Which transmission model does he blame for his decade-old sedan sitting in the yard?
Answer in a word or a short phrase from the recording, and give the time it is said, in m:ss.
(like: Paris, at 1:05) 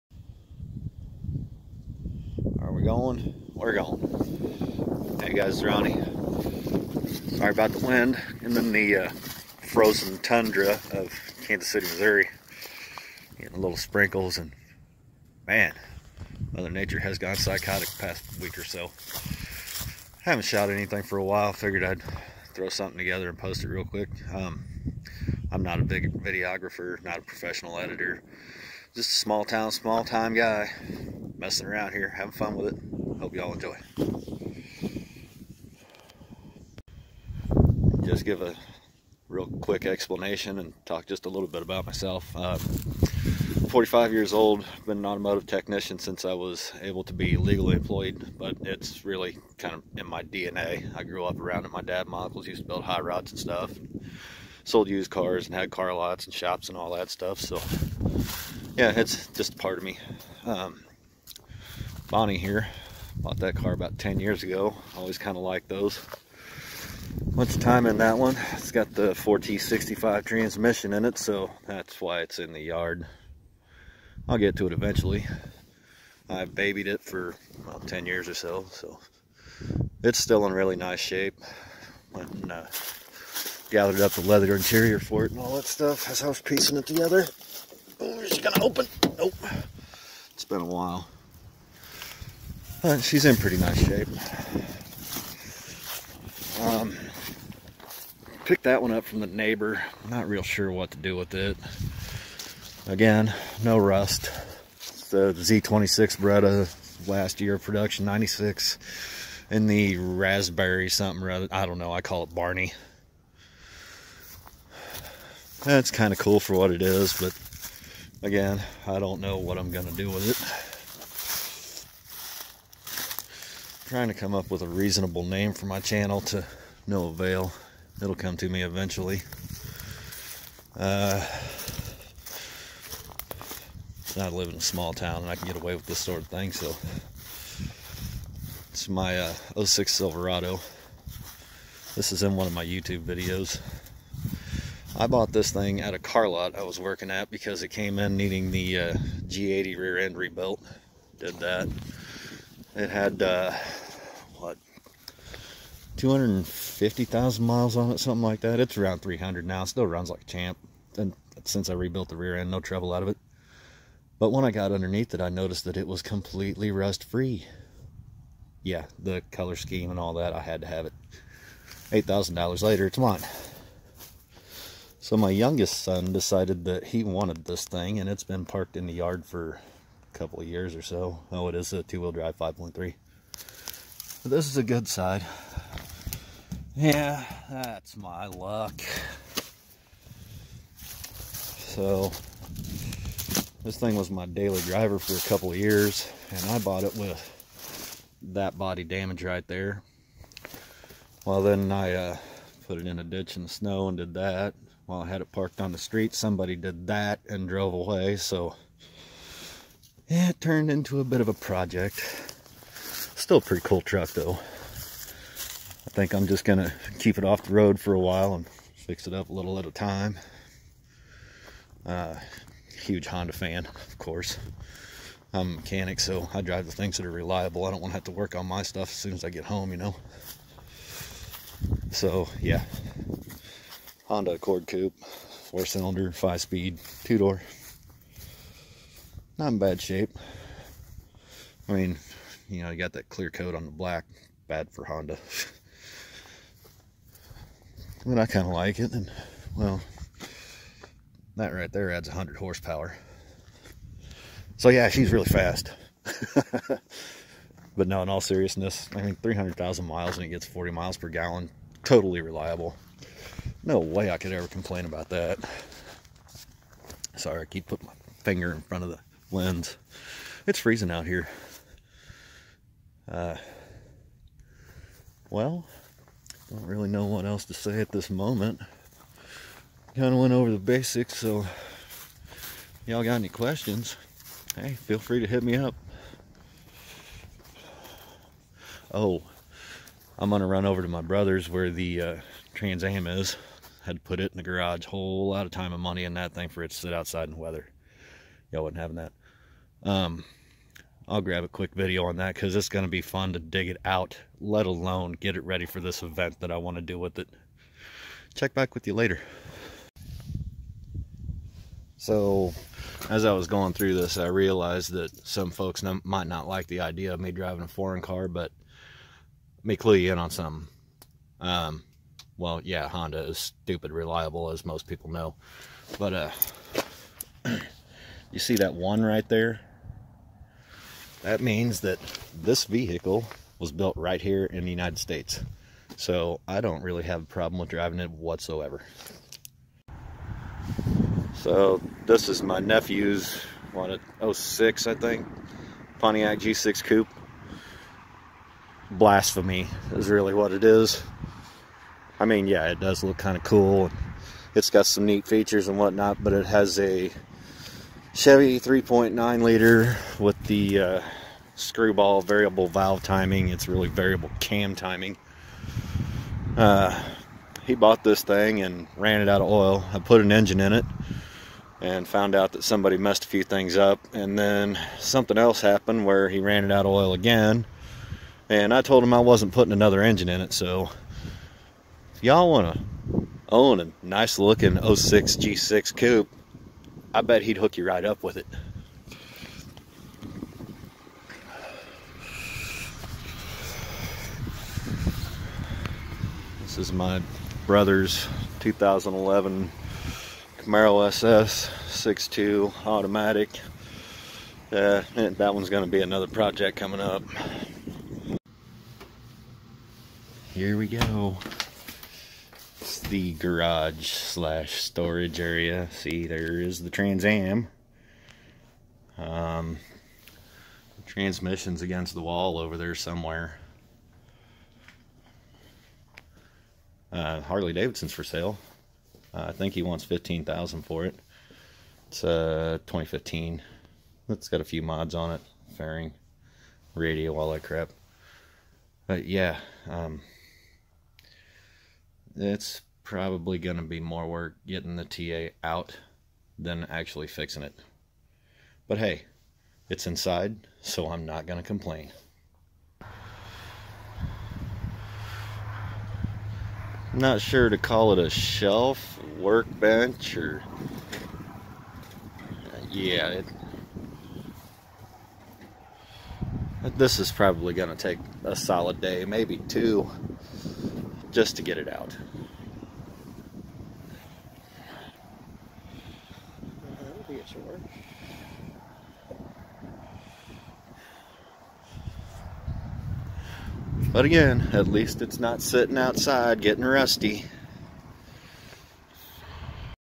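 4T65, at 1:09.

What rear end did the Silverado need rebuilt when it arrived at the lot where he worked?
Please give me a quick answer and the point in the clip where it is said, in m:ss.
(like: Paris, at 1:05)
G80, at 2:29.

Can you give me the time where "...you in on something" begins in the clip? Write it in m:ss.
5:19.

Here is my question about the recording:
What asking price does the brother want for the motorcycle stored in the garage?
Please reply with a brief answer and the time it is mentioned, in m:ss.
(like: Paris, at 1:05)
15000, at 7:10.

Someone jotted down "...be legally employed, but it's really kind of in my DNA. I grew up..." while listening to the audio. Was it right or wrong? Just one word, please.
right.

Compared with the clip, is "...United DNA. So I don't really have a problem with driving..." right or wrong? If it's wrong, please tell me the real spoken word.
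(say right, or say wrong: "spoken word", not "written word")
wrong: "States", not "DNA".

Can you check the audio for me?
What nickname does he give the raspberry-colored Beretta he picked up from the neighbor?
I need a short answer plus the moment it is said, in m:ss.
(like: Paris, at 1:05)
Barney, at 1:52.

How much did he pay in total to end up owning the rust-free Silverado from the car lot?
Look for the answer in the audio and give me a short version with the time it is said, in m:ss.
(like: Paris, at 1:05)
$8,000, at 2:51.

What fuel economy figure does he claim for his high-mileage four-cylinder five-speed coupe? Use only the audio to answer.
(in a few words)
40 miles per gallon.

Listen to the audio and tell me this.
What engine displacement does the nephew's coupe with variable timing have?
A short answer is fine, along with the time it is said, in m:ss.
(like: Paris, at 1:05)
3.9 liter, at 5:58.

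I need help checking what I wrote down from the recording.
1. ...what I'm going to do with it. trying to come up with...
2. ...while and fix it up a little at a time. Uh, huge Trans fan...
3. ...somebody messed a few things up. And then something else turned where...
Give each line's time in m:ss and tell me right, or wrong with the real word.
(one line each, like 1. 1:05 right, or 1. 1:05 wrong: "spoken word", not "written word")
1. 1:59 right
2. 3:37 wrong: "Honda", not "Trans"
3. 6:12 wrong: "happened", not "turned".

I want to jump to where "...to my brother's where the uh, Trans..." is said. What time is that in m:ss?
4:50.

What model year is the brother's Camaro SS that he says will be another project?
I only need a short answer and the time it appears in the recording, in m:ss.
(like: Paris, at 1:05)
2011, at 6:38.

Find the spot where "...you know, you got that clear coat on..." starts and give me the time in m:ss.
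4:02.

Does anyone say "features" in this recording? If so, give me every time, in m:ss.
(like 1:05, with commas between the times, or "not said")
5:55.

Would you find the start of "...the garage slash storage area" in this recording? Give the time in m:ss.
6:53.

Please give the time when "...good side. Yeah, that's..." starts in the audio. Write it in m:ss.
3:04.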